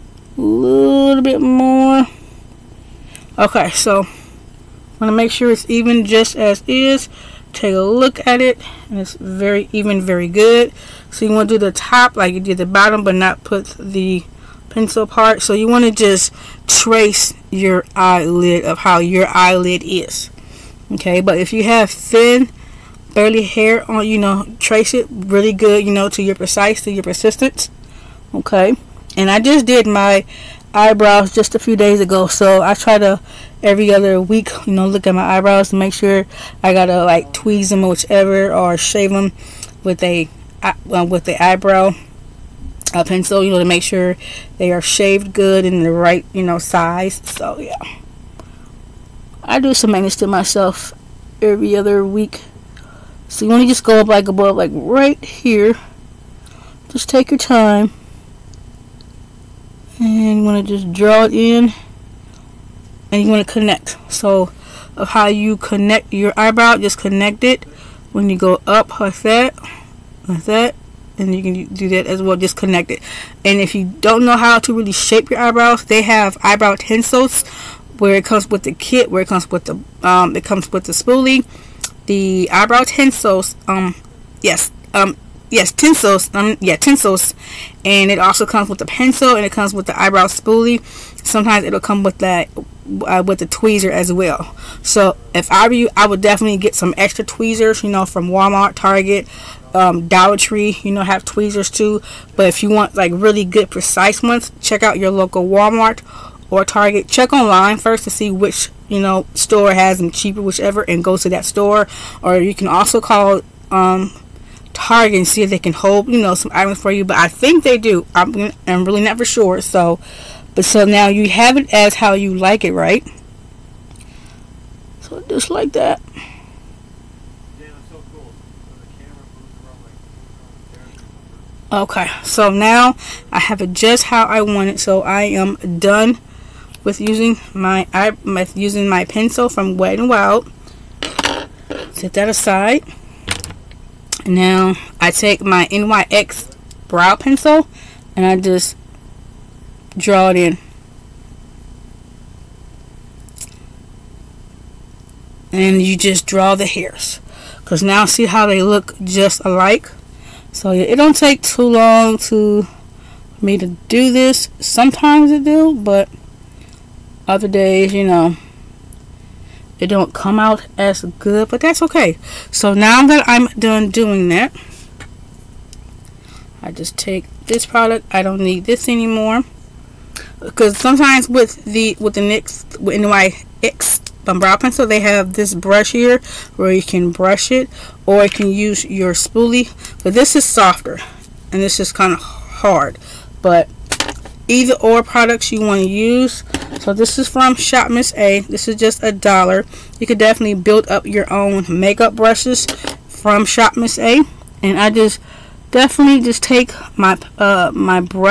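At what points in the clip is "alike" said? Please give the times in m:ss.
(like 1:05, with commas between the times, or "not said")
2:39.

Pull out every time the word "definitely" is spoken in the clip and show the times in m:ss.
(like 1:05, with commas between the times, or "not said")
1:36, 3:20, 3:25.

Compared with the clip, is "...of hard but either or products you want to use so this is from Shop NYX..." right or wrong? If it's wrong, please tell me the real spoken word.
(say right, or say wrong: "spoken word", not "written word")
wrong: "Miss", not "NYX".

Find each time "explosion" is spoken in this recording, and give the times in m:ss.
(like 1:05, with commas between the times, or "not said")
not said.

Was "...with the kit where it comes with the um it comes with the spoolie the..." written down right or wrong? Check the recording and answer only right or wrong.
right.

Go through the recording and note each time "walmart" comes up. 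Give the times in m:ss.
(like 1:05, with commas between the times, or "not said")
1:38, 1:45.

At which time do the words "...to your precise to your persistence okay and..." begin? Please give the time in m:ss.
0:26.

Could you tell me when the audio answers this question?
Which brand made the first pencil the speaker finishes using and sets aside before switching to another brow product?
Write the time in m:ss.
2:19.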